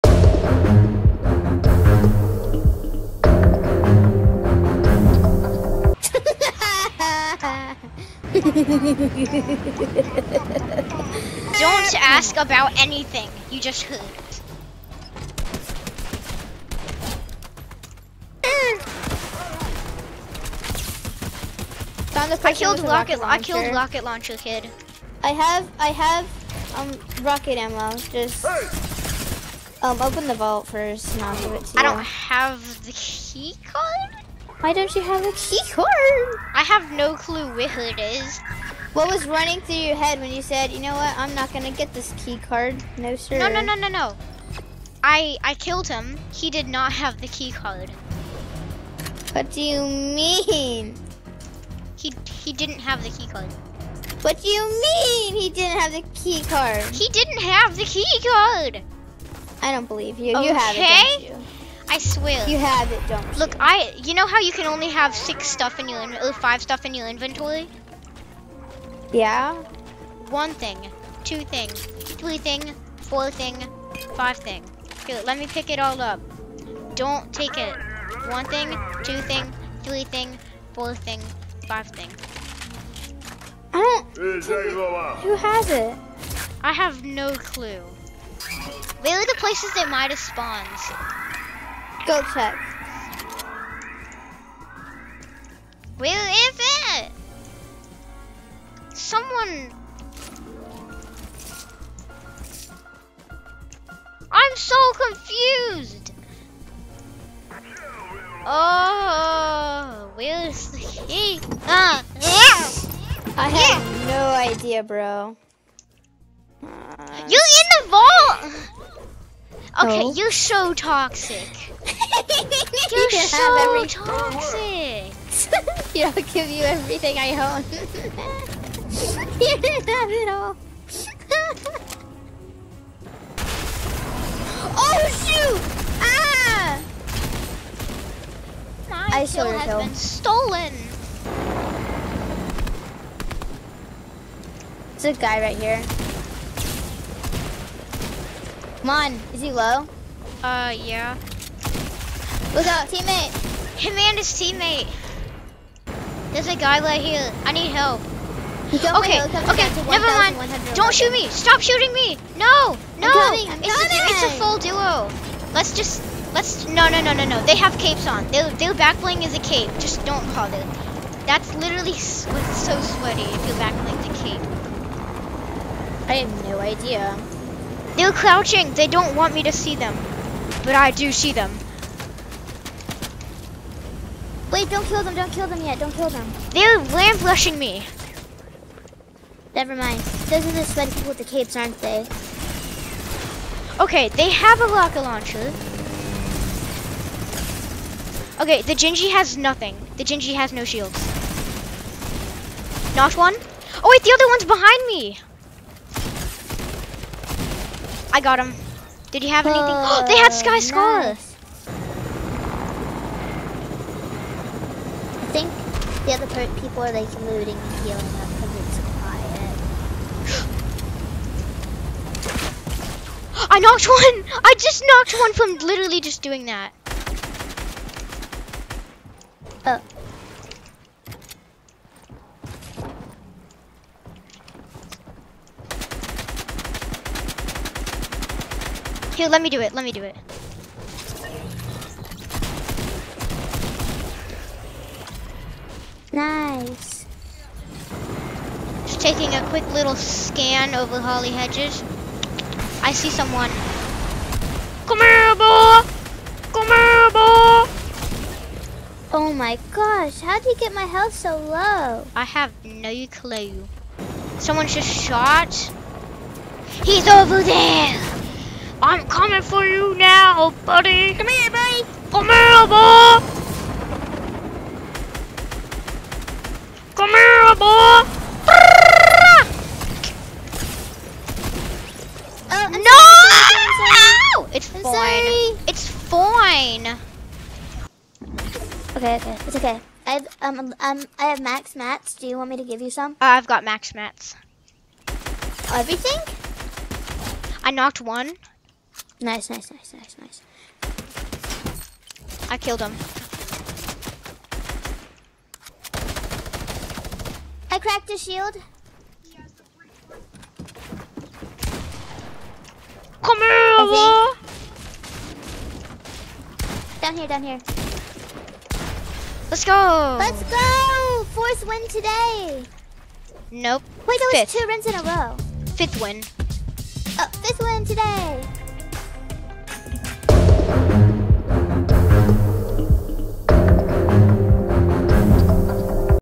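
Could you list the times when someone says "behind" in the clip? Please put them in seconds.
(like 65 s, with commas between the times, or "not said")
204 s.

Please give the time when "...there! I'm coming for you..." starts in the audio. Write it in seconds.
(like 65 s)
267 s.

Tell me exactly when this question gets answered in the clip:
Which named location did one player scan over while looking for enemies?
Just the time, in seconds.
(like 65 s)
250 s.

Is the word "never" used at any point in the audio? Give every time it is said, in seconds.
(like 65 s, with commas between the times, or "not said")
159 s, 189 s.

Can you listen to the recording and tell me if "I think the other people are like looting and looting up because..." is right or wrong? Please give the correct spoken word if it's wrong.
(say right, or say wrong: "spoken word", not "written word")
wrong: "healing", not "looting".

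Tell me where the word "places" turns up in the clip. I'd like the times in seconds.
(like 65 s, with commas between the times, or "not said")
89 s.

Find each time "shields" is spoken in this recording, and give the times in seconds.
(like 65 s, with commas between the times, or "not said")
200 s, 308 s.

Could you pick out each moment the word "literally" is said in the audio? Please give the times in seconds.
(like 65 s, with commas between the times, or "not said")
171 s, 225 s.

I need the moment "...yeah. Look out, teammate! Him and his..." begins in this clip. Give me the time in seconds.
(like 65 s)
150 s.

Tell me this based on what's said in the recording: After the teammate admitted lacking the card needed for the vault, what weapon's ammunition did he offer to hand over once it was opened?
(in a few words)
Rocket ammo.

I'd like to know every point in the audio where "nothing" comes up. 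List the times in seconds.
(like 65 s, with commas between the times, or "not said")
199 s.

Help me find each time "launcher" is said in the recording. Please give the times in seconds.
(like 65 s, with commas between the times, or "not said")
24 s, 195 s.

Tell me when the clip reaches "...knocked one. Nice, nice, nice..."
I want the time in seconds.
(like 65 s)
297 s.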